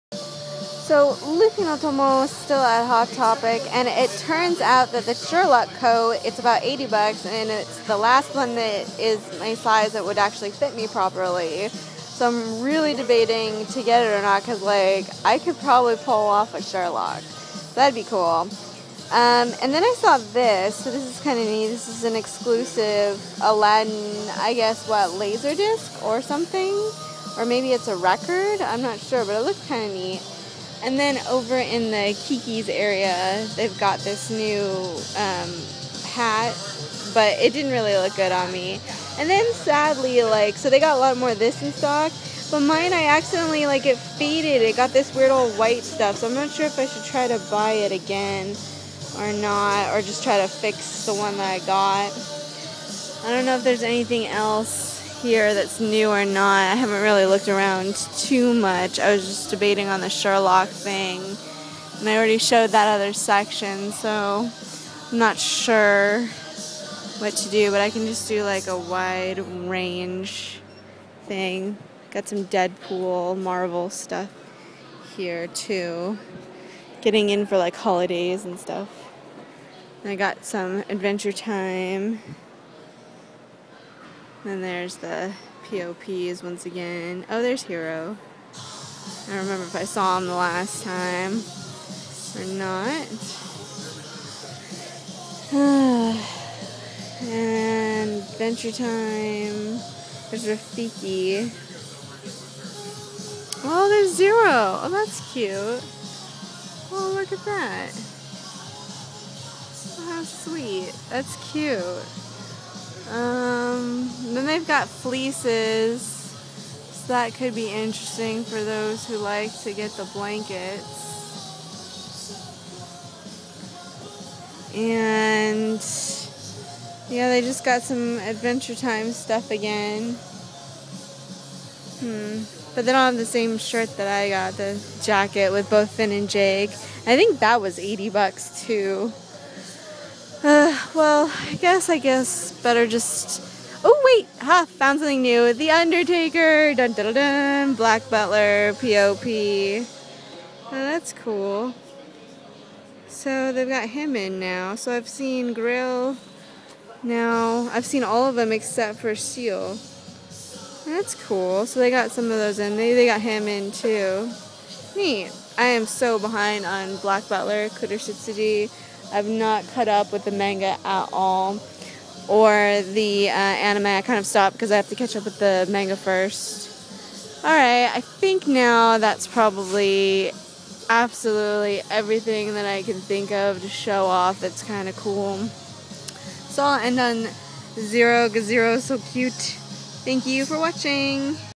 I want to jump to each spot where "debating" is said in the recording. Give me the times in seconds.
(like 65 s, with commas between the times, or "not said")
12 s, 59 s.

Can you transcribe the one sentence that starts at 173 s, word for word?
I kind of stopped because I have to catch up with the manga first.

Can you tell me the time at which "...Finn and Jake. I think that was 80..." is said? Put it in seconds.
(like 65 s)
135 s.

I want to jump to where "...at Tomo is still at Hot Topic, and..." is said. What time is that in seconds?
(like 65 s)
1 s.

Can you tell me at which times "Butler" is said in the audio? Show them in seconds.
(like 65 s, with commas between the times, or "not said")
148 s, 167 s.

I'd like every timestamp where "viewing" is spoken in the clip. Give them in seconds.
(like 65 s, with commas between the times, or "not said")
not said.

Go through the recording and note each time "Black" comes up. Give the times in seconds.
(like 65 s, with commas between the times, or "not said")
147 s, 167 s.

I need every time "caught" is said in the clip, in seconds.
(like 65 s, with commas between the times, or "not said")
169 s.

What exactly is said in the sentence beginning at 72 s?
Got some Deadpool, Marvel stuff here too.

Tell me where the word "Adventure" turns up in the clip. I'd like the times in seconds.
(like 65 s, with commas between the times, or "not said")
80 s, 98 s, 128 s.